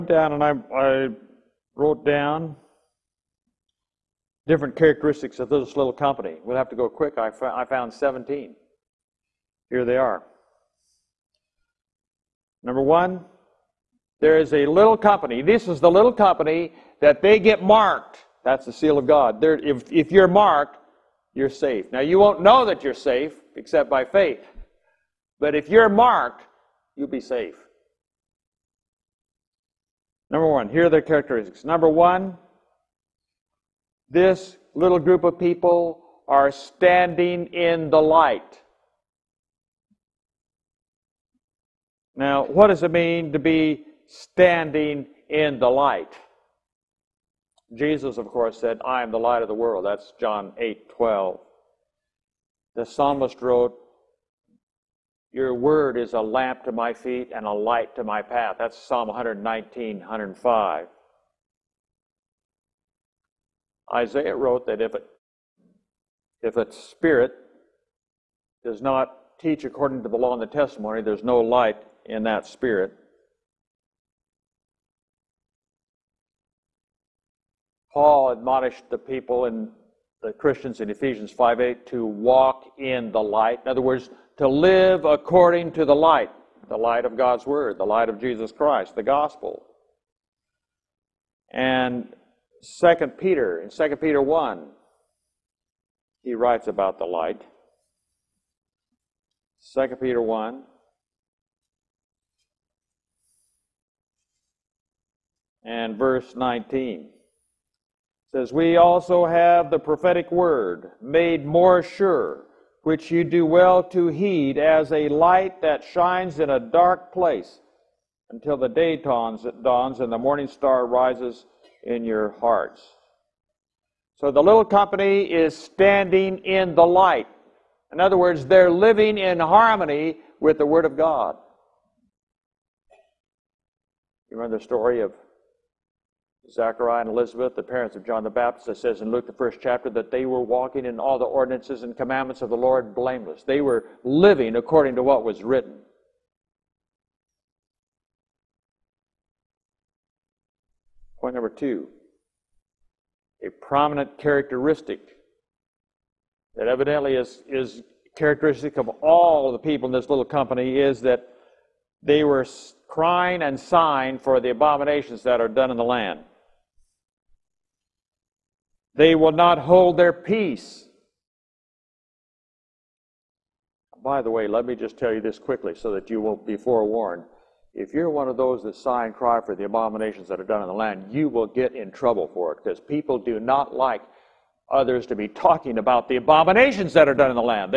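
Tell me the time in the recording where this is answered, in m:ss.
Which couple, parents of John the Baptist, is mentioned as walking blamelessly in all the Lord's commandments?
2:16.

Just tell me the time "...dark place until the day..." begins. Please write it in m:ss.
1:56.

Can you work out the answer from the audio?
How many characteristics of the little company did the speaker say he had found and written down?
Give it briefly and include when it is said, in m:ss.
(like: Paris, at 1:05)
17, at 0:07.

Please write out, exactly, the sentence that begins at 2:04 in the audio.
So the little company is standing in the light.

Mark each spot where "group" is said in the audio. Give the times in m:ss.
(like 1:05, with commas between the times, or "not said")
0:34.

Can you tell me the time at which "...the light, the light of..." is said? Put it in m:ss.
1:25.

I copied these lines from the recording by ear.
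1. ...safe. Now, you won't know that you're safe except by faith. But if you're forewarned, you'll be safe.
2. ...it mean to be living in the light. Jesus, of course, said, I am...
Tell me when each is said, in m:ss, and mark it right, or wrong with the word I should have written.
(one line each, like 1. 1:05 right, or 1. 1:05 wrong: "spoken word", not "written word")
1. 0:21 wrong: "marked", not "forewarned"
2. 0:42 wrong: "standing", not "living".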